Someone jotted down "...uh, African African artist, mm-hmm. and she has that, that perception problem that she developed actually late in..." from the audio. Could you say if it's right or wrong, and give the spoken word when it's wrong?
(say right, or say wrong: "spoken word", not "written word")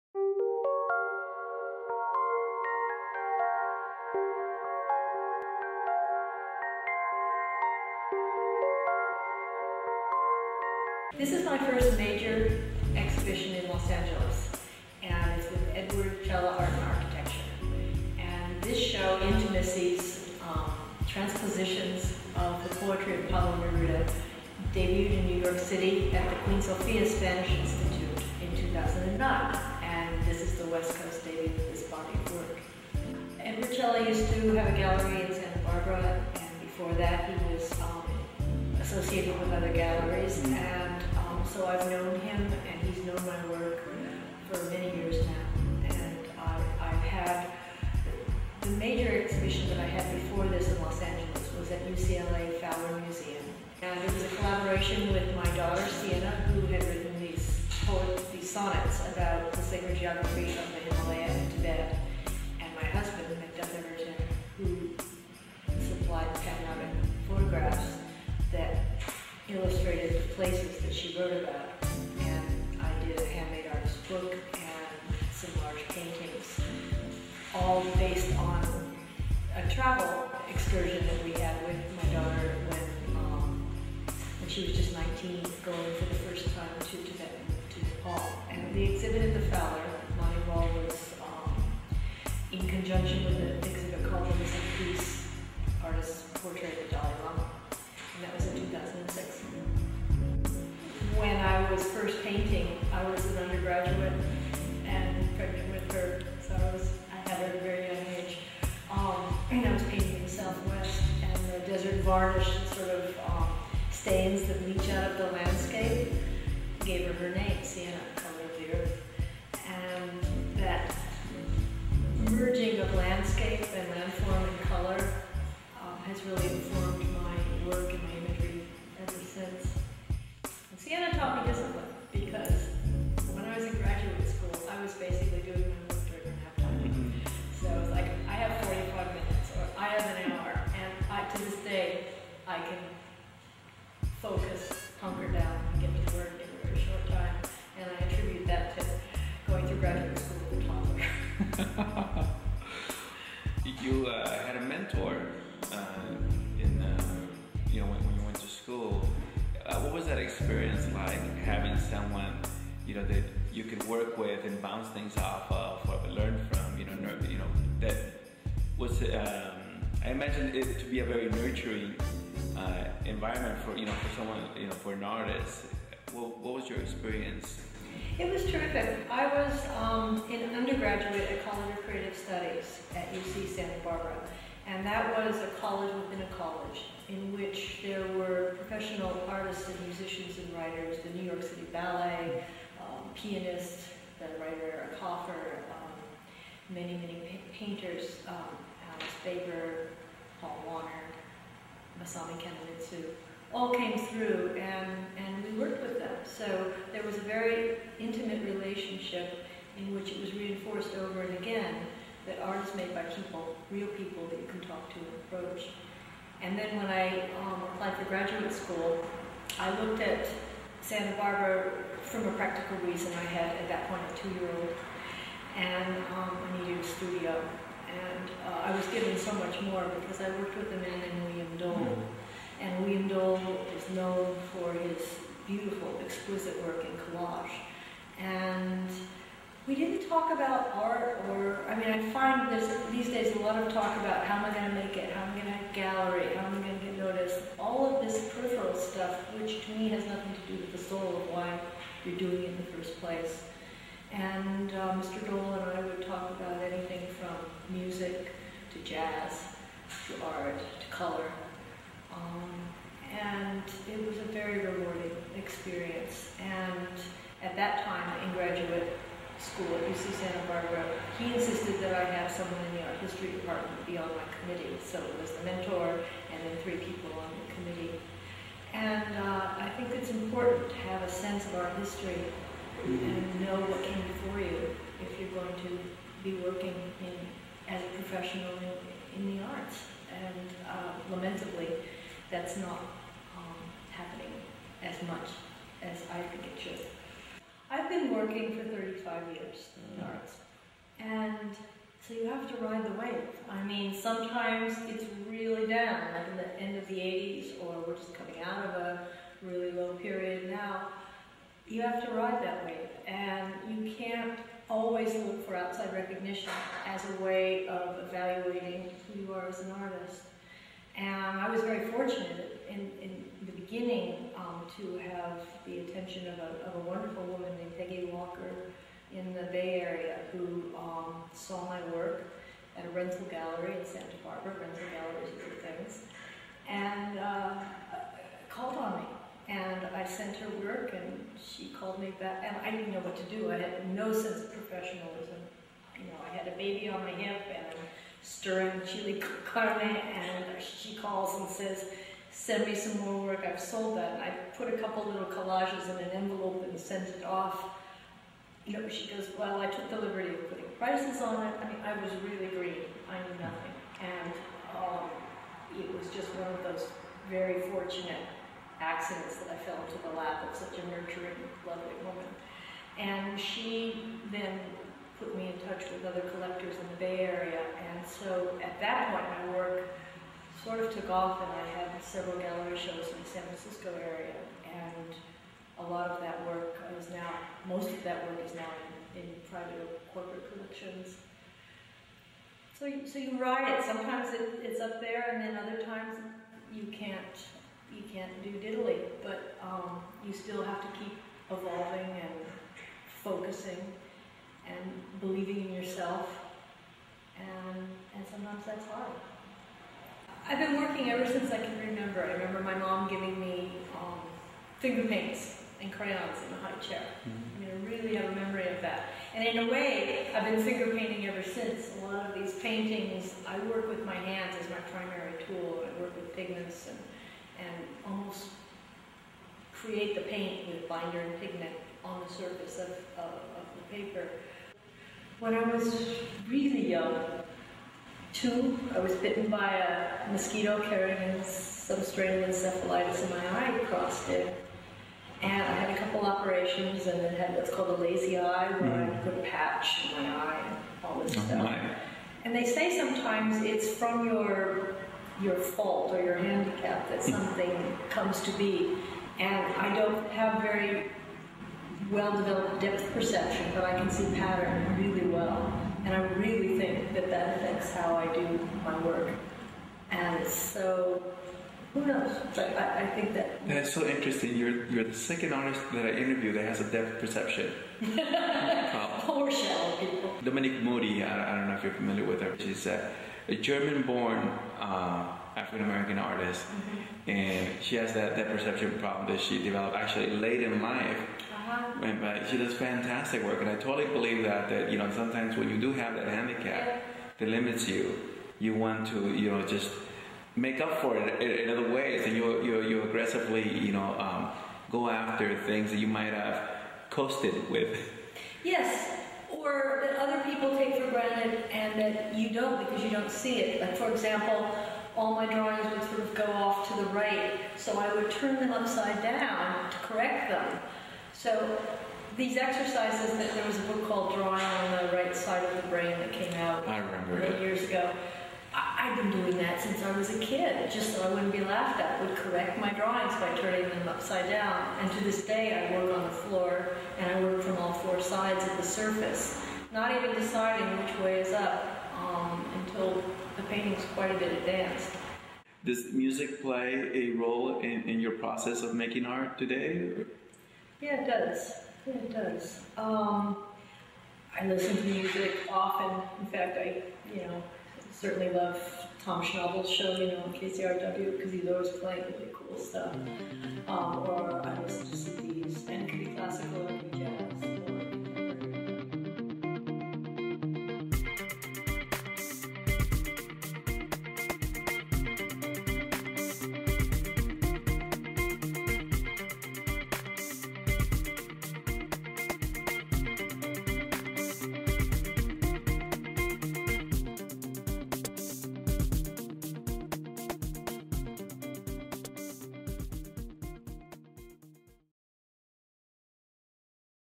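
wrong: "American", not "African".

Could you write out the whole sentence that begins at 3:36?
And then when I um, applied for graduate school, I looked at Santa Barbara from a practical reason.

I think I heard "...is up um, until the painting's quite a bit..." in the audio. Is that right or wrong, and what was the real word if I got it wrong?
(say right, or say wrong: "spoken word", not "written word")
right.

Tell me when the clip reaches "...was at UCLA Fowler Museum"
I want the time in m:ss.
0:51.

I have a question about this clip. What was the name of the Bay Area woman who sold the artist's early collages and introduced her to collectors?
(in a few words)
Peggy Walker.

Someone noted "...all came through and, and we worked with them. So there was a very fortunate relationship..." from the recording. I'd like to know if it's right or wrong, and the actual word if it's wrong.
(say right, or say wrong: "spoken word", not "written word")
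wrong: "intimate", not "fortunate".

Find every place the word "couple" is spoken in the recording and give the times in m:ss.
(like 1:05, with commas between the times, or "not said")
5:54, 7:25.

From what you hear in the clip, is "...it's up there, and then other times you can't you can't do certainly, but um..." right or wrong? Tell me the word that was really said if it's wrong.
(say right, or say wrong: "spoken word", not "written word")
wrong: "diddly", not "certainly".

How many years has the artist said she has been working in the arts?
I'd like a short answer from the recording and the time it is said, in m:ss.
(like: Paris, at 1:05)
35, at 4:58.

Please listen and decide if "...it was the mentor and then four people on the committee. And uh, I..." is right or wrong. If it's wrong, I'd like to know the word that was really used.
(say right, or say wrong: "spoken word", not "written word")
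wrong: "three", not "four".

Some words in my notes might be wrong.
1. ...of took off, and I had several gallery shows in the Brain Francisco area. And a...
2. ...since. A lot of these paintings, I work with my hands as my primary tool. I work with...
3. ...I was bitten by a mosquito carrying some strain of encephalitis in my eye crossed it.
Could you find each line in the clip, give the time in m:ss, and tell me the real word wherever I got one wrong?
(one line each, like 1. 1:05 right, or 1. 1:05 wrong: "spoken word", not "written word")
1. 6:20 wrong: "San", not "Brain"
2. 7:01 right
3. 7:18 right.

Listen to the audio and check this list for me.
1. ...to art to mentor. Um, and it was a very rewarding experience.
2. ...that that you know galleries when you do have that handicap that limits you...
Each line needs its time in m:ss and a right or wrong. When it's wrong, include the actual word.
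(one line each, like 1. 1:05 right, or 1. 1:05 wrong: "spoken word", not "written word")
1. 4:20 wrong: "color", not "mentor"
2. 8:14 wrong: "sometimes", not "galleries".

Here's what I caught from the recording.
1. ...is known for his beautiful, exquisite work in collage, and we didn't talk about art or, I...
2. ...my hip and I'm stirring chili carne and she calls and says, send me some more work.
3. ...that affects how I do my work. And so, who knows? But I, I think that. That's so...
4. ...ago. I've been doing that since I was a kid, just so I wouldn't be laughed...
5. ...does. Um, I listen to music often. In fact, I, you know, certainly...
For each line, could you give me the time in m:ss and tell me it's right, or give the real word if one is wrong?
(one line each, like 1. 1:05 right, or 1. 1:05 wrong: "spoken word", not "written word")
1. 3:53 right
2. 5:47 right
3. 7:47 right
4. 8:47 right
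5. 9:12 right.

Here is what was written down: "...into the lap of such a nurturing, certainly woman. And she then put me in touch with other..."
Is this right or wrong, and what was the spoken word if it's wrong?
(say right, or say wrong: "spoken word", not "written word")
wrong: "lovely", not "certainly".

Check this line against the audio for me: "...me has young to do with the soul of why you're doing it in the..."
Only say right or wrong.
wrong.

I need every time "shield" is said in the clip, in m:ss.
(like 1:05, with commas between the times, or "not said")
not said.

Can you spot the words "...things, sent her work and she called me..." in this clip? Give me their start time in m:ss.
5:35.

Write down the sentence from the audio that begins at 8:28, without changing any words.
Yes, or that other people take for granted and that you don't because you don't see it.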